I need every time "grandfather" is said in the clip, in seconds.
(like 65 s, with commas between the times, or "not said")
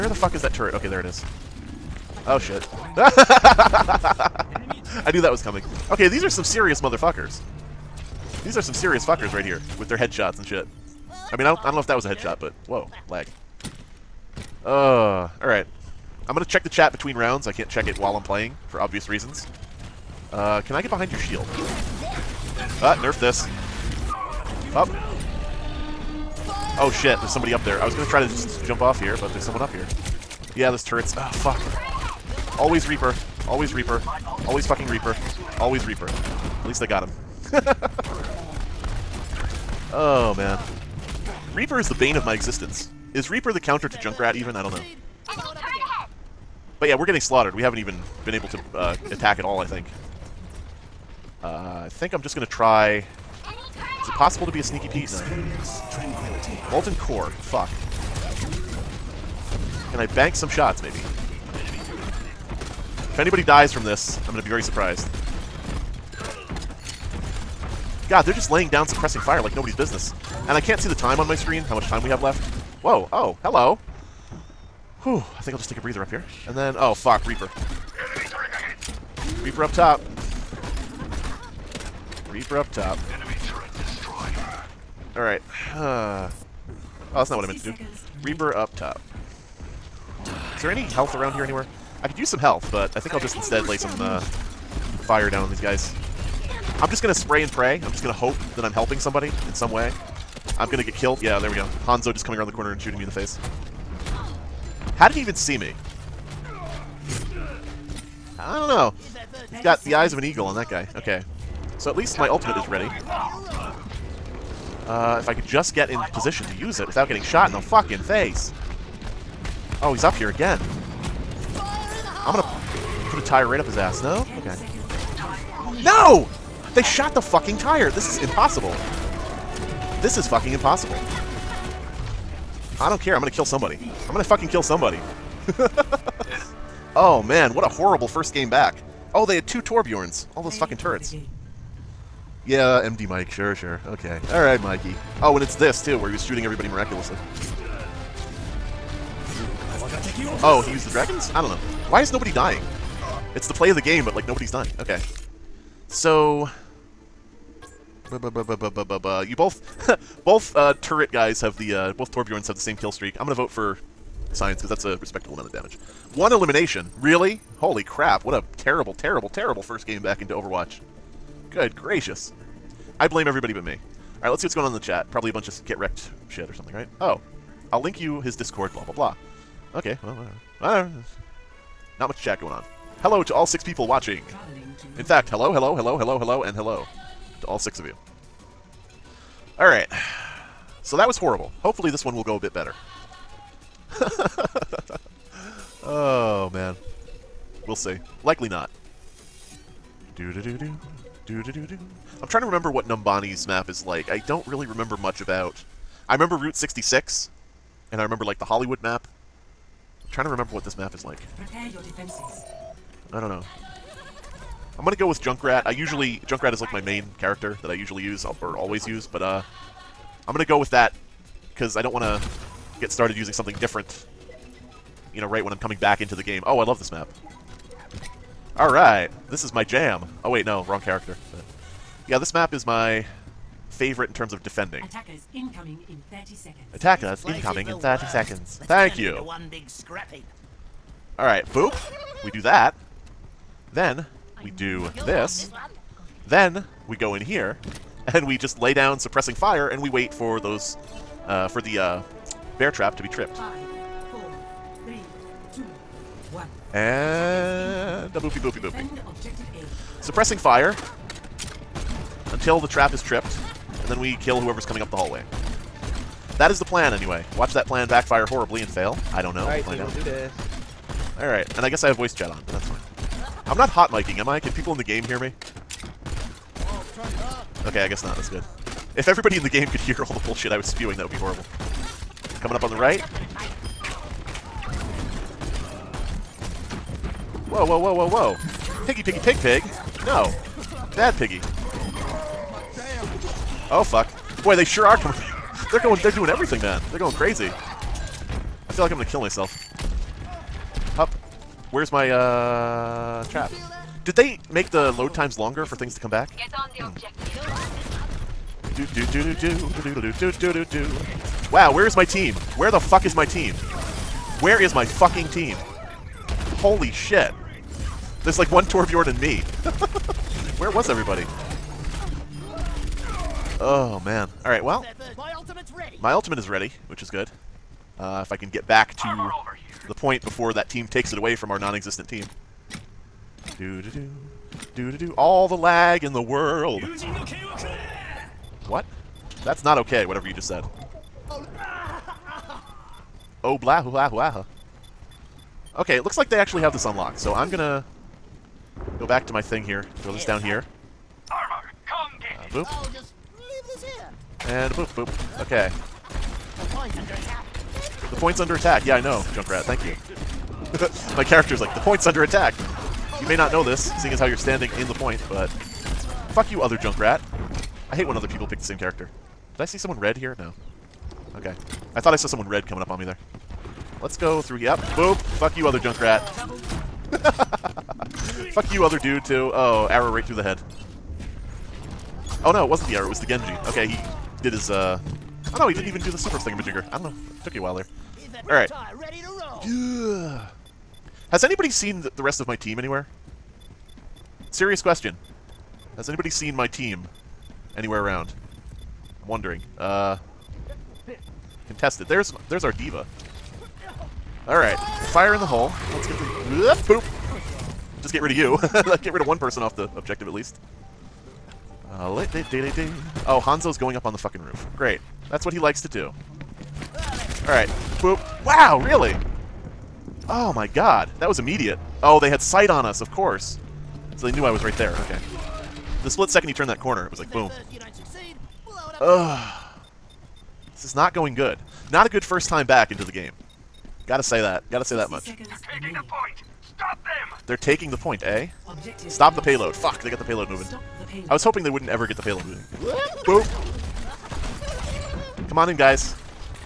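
not said.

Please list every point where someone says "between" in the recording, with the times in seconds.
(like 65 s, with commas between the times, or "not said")
16 s.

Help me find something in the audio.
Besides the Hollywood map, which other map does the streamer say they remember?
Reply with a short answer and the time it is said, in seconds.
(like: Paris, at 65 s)
Route 66, at 206 s.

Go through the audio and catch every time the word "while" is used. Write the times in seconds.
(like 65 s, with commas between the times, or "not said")
17 s, 387 s.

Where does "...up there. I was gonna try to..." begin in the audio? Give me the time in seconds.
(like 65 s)
27 s.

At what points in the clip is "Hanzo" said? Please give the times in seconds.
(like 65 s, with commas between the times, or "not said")
101 s, 413 s.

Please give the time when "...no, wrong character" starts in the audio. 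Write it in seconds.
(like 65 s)
230 s.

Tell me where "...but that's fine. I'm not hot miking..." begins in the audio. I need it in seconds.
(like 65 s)
272 s.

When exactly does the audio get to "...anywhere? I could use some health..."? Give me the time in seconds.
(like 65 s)
91 s.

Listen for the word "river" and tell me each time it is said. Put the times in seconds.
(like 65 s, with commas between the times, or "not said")
not said.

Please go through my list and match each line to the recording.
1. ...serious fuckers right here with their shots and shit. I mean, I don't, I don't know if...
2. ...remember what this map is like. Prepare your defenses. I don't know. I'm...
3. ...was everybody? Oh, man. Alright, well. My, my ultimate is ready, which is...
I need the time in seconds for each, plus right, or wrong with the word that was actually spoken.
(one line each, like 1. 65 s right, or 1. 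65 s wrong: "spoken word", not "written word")
1. 8 s wrong: "headshots", not "shots"
2. 210 s right
3. 320 s right.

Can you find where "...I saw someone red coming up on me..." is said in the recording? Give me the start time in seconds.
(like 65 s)
372 s.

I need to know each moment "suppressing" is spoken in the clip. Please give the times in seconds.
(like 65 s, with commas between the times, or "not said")
68 s, 248 s, 260 s.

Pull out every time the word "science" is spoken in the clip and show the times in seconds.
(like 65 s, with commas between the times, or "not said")
164 s.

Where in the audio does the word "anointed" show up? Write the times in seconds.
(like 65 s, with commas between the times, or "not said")
not said.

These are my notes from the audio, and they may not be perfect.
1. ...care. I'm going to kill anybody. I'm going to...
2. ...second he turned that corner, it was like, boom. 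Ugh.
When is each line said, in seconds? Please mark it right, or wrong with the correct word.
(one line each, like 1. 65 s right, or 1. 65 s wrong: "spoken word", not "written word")
1. 133 s wrong: "somebody", not "anybody"
2. 426 s right.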